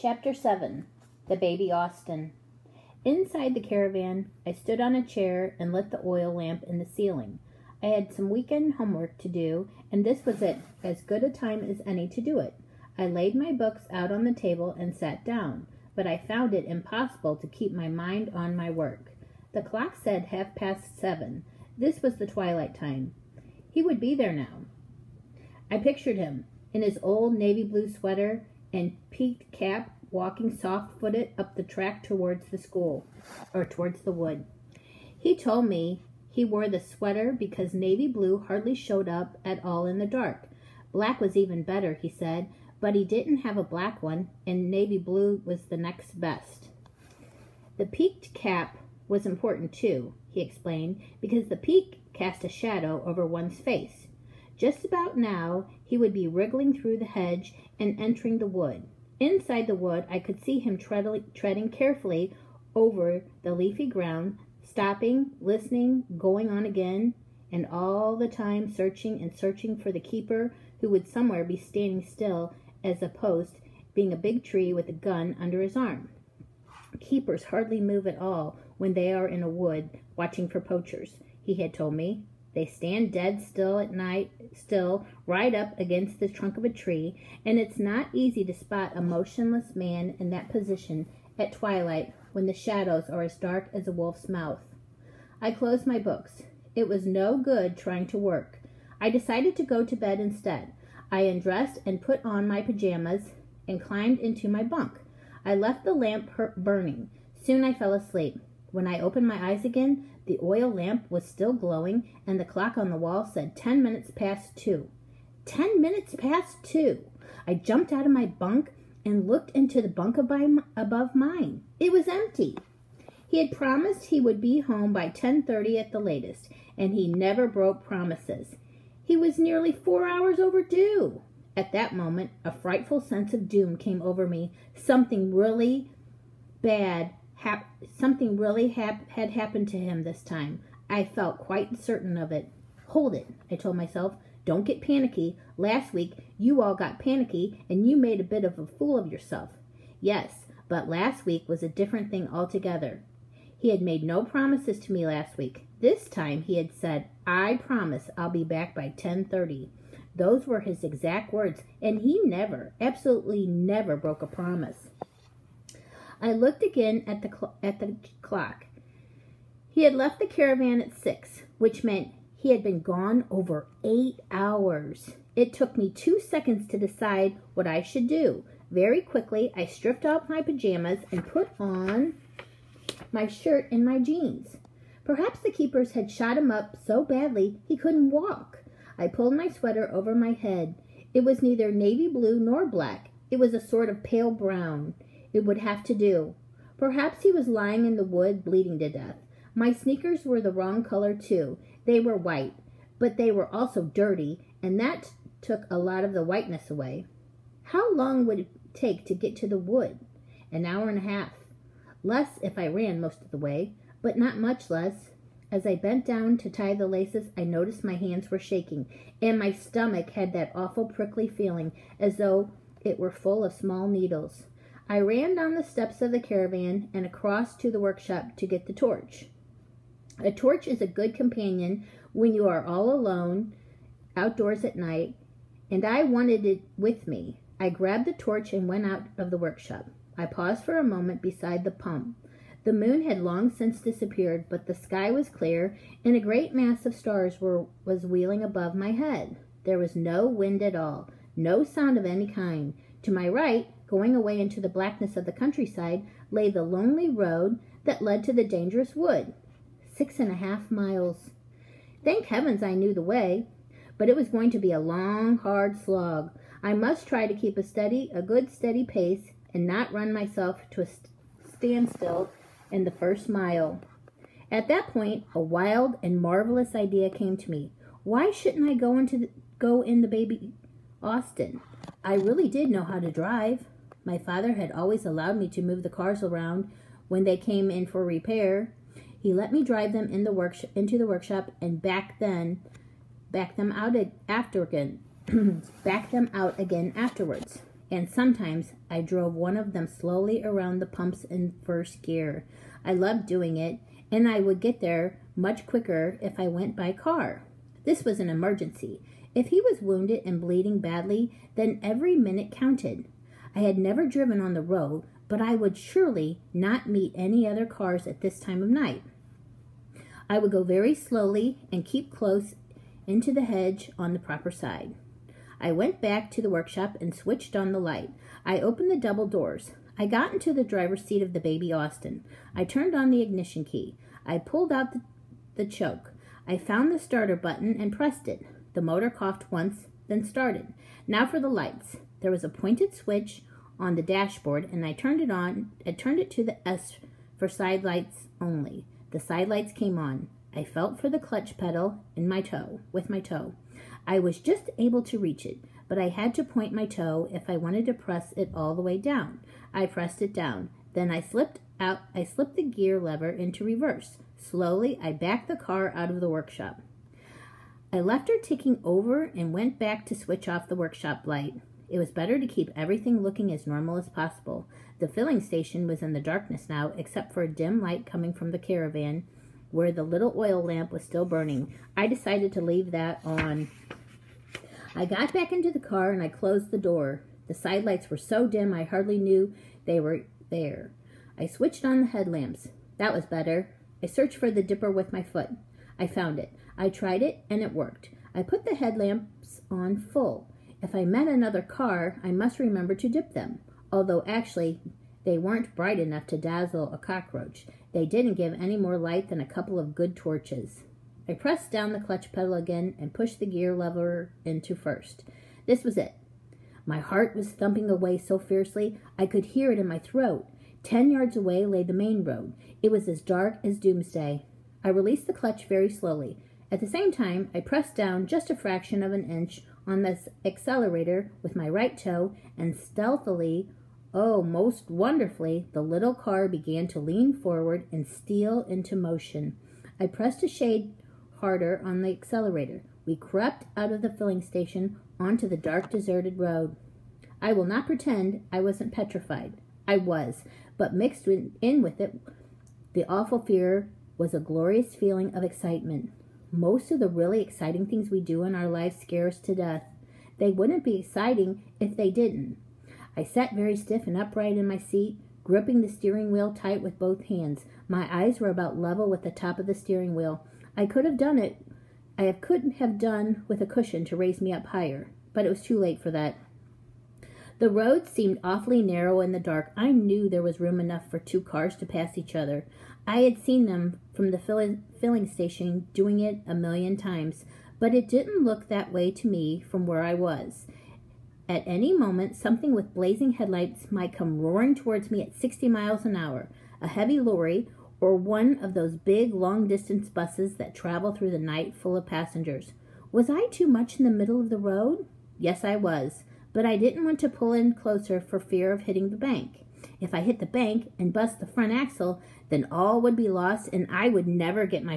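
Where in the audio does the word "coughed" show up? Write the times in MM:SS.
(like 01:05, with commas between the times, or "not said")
05:39.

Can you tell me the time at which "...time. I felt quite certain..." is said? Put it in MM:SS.
02:20.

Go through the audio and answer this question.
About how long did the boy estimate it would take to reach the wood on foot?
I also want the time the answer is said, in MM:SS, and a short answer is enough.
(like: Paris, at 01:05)
An hour and a half, at 03:30.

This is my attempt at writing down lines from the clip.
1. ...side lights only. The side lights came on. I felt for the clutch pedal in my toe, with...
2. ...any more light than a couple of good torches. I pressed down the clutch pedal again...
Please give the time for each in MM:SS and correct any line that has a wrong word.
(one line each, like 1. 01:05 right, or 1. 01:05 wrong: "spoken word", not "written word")
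1. 05:47 right
2. 06:48 right.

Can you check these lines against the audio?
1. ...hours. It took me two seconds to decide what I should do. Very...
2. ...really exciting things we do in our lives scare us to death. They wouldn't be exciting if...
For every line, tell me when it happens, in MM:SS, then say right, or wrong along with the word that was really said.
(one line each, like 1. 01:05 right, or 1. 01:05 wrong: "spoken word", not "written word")
1. 02:54 right
2. 07:37 right.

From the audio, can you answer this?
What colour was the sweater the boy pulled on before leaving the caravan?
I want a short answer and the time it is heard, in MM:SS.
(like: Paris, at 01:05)
Pale brown, at 03:14.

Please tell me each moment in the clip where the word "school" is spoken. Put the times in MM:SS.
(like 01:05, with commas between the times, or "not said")
00:32.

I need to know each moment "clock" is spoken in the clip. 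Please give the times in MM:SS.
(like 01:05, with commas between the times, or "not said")
00:19, 01:52, 02:48.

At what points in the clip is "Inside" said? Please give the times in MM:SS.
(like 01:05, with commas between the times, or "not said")
00:03, 00:59.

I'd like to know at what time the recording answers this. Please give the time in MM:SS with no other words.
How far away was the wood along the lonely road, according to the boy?
04:19.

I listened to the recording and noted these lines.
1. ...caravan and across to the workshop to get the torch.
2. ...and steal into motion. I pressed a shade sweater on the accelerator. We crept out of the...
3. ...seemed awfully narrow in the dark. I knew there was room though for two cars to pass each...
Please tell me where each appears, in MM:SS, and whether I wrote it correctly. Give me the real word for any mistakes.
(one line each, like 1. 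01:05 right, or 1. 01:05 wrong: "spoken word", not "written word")
1. 03:46 right
2. 07:17 wrong: "harder", not "sweater"
3. 07:58 wrong: "enough", not "though".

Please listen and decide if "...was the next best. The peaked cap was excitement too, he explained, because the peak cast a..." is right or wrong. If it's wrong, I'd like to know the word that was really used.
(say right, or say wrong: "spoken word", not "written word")
wrong: "important", not "excitement".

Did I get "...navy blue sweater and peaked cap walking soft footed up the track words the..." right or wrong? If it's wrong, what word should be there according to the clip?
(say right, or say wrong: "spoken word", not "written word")
wrong: "towards", not "words".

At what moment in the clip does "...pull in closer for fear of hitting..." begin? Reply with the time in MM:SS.
08:27.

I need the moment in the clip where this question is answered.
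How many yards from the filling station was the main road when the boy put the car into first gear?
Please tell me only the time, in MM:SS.
07:00.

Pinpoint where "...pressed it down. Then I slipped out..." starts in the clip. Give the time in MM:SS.
05:59.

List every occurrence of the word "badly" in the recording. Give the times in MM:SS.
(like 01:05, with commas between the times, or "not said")
03:07, 05:10.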